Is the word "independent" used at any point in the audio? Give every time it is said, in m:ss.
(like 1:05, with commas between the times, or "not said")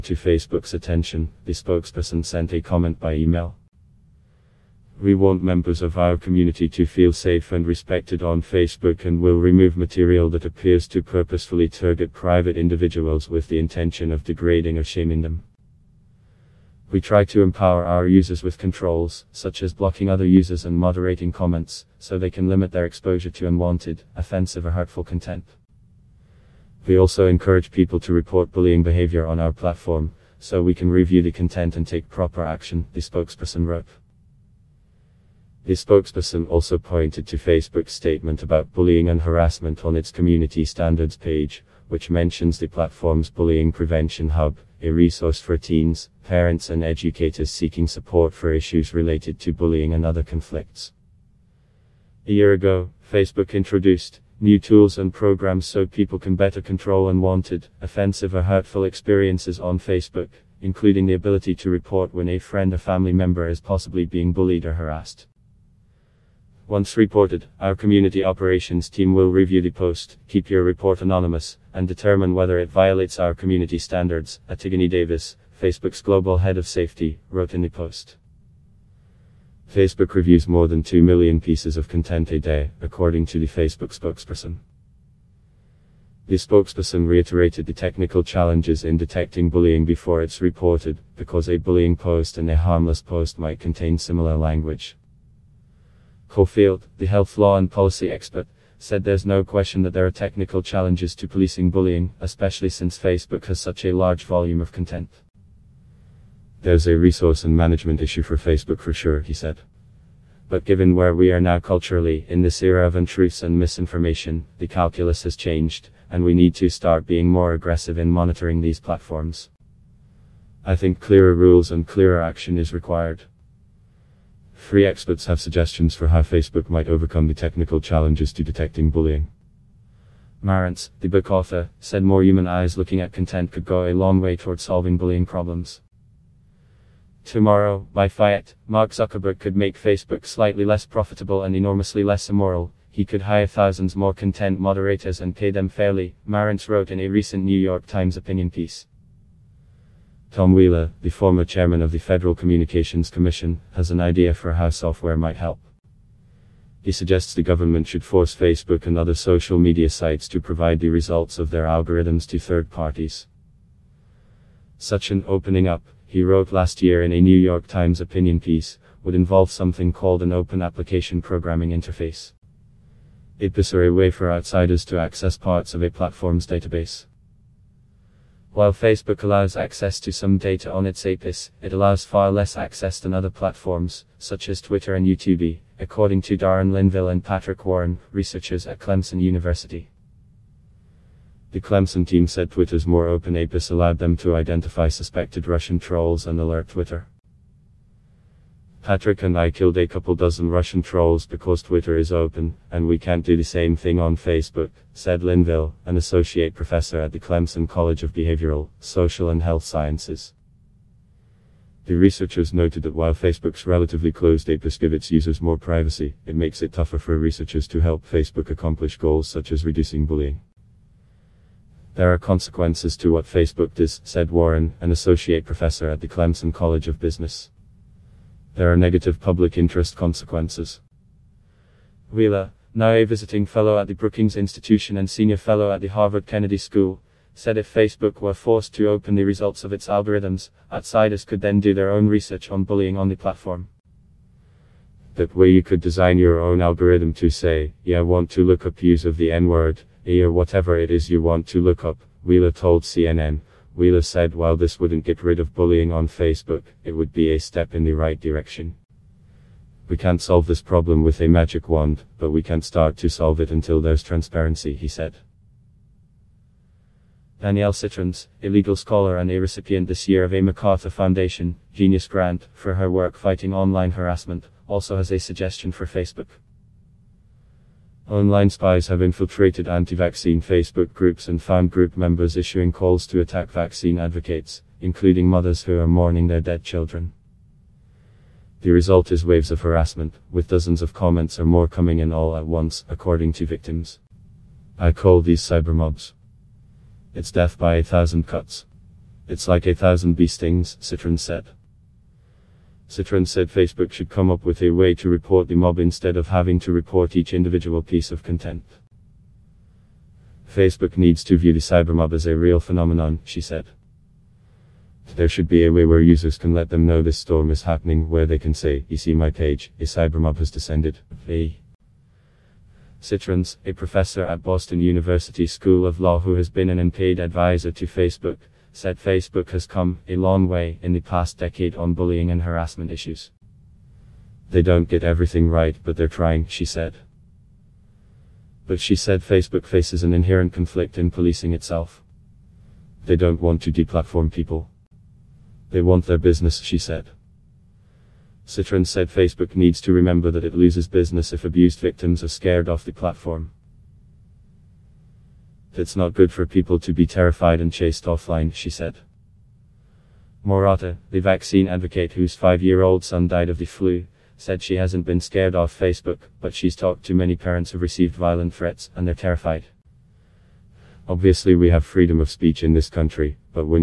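not said.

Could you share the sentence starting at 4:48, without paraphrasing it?
The result is waves of harassment, with dozens of comments or more coming in all at once, according to victims.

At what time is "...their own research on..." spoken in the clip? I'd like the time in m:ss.
4:01.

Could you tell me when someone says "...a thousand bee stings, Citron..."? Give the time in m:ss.
4:59.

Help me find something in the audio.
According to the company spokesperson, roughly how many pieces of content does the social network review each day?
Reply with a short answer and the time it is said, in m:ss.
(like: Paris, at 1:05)
more than 2 million, at 1:20.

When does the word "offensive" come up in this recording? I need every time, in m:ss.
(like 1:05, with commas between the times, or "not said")
0:24, 0:57.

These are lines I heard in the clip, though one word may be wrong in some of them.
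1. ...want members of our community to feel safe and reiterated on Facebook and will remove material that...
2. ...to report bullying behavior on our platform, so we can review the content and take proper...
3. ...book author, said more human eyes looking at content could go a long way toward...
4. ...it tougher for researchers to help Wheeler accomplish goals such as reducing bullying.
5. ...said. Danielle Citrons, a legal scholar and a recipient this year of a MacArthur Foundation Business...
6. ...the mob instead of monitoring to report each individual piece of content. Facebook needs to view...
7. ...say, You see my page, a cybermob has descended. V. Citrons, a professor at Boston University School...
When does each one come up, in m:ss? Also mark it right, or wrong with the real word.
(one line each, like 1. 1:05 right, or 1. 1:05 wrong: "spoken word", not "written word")
1. 0:05 wrong: "respected", not "reiterated"
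2. 0:28 right
3. 2:11 right
4. 3:36 wrong: "Facebook", not "Wheeler"
5. 4:24 wrong: "Genius", not "Business"
6. 5:05 wrong: "having", not "monitoring"
7. 5:18 right.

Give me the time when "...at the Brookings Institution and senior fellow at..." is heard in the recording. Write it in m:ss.
3:53.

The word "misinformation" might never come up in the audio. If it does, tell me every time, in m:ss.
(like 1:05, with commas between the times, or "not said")
1:53.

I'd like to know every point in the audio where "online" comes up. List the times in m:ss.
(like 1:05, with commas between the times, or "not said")
4:33, 4:38.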